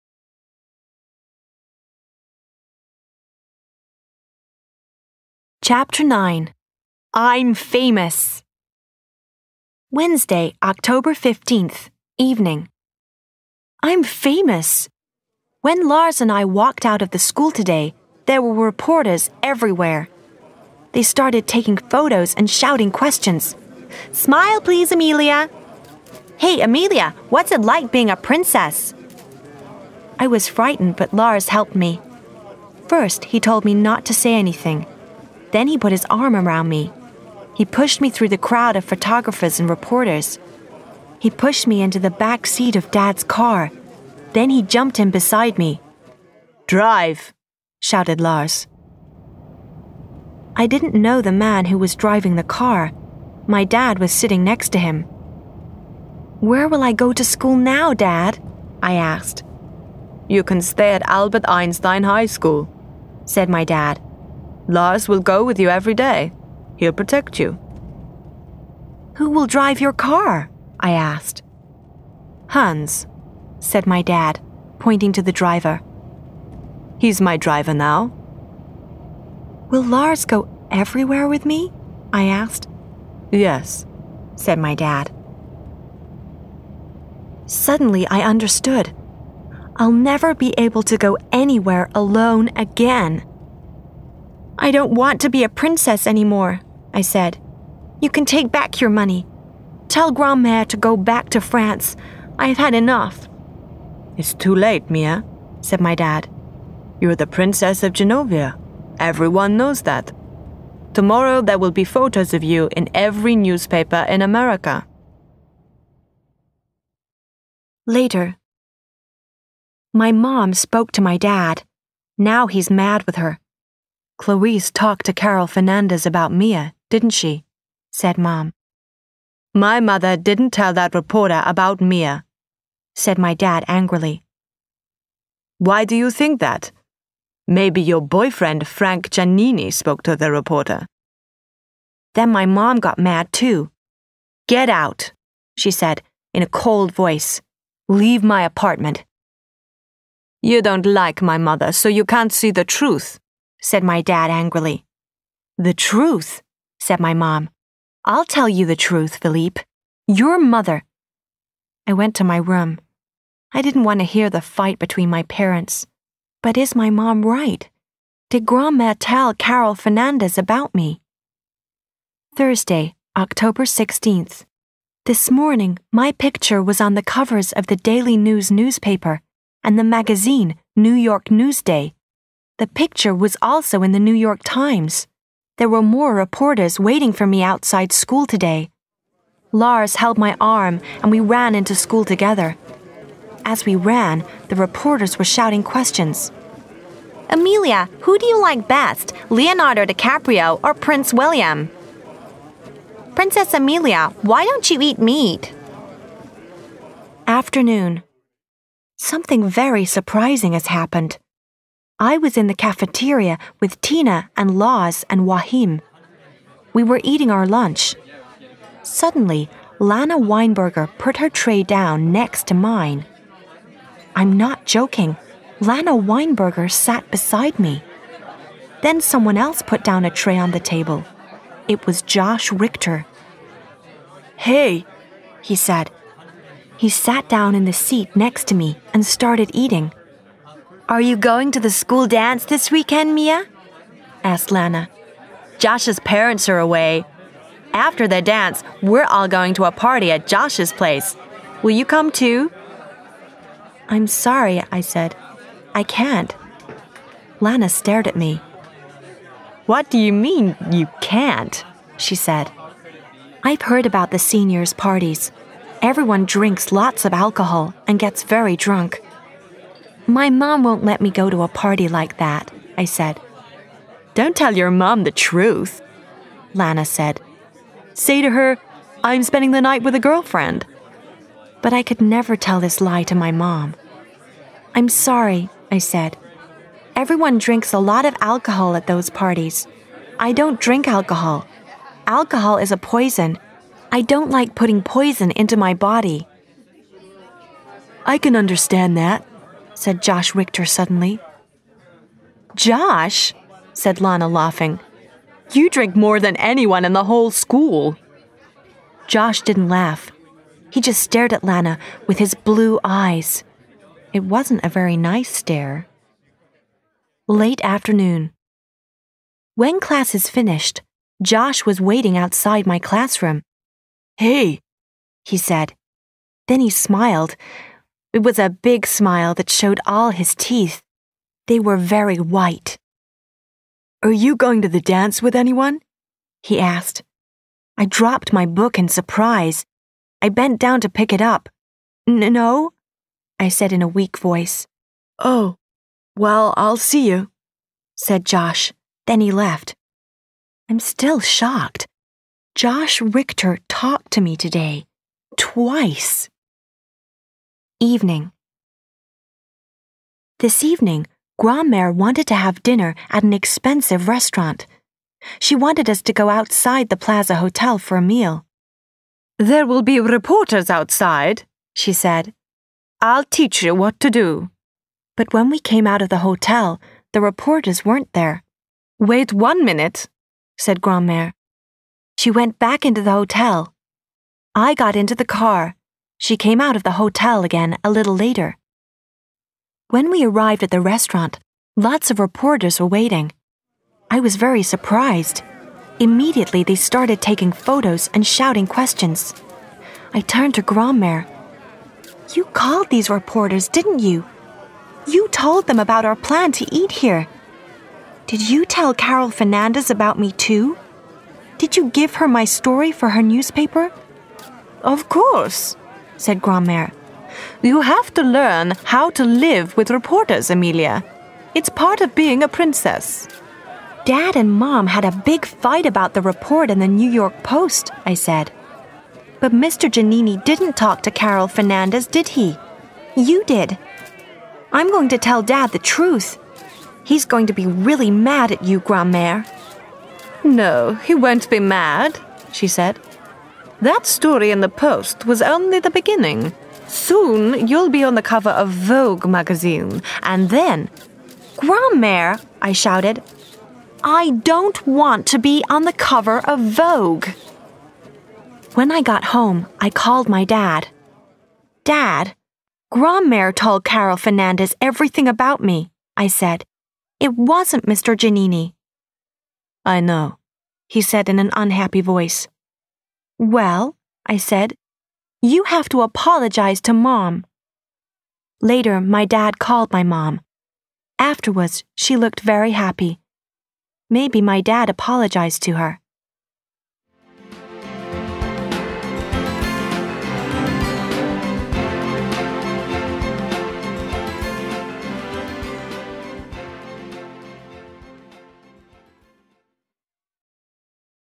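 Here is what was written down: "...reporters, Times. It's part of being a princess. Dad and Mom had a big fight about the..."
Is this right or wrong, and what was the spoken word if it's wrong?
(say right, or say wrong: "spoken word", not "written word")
wrong: "Amelia", not "Times".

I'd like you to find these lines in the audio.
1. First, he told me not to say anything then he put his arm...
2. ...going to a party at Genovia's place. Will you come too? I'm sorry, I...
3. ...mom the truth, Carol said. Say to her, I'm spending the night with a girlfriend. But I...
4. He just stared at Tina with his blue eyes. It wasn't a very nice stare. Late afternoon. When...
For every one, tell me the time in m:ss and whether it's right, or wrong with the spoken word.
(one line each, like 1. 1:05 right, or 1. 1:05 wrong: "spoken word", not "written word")
1. 0:32 right
2. 4:09 wrong: "Josh", not "Genovia"
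3. 4:34 wrong: "Lana", not "Carol"
4. 5:10 wrong: "Lana", not "Tina".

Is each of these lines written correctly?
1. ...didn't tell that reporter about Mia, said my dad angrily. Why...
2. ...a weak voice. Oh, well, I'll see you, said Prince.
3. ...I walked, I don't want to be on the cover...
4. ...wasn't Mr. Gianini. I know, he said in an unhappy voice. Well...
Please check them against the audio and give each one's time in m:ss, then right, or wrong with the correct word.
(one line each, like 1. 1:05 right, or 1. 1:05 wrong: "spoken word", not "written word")
1. 2:10 right
2. 5:43 wrong: "Josh", not "Prince"
3. 7:32 wrong: "shouted", not "walked"
4. 7:47 right.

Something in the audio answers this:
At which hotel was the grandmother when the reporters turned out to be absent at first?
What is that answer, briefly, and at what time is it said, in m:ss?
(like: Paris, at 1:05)
Plaza Hotel, at 6:06.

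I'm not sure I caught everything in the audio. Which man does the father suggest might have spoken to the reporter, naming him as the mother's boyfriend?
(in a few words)
Frank Gianini.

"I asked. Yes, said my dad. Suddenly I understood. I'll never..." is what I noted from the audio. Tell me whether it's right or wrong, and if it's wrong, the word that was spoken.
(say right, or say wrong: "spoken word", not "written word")
right.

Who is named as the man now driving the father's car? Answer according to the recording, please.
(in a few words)
Hans.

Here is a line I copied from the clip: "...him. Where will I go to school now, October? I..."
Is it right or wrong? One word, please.
wrong.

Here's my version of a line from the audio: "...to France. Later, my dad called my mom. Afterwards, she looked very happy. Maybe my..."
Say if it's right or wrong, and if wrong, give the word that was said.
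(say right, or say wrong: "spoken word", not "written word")
wrong: "Mom", not "France".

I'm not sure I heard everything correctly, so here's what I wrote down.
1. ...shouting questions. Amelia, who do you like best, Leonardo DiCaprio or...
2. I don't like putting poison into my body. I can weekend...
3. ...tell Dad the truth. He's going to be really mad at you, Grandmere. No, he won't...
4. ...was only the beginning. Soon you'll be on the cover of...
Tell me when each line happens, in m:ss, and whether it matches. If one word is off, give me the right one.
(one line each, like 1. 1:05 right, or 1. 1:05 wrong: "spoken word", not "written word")
1. 3:15 right
2. 4:53 wrong: "understand", not "weekend"
3. 7:15 right
4. 7:25 right.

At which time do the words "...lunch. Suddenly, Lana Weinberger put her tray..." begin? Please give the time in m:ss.
3:37.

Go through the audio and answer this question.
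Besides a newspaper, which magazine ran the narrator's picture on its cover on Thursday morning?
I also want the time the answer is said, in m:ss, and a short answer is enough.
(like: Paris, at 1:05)
New York Newsday, at 3:00.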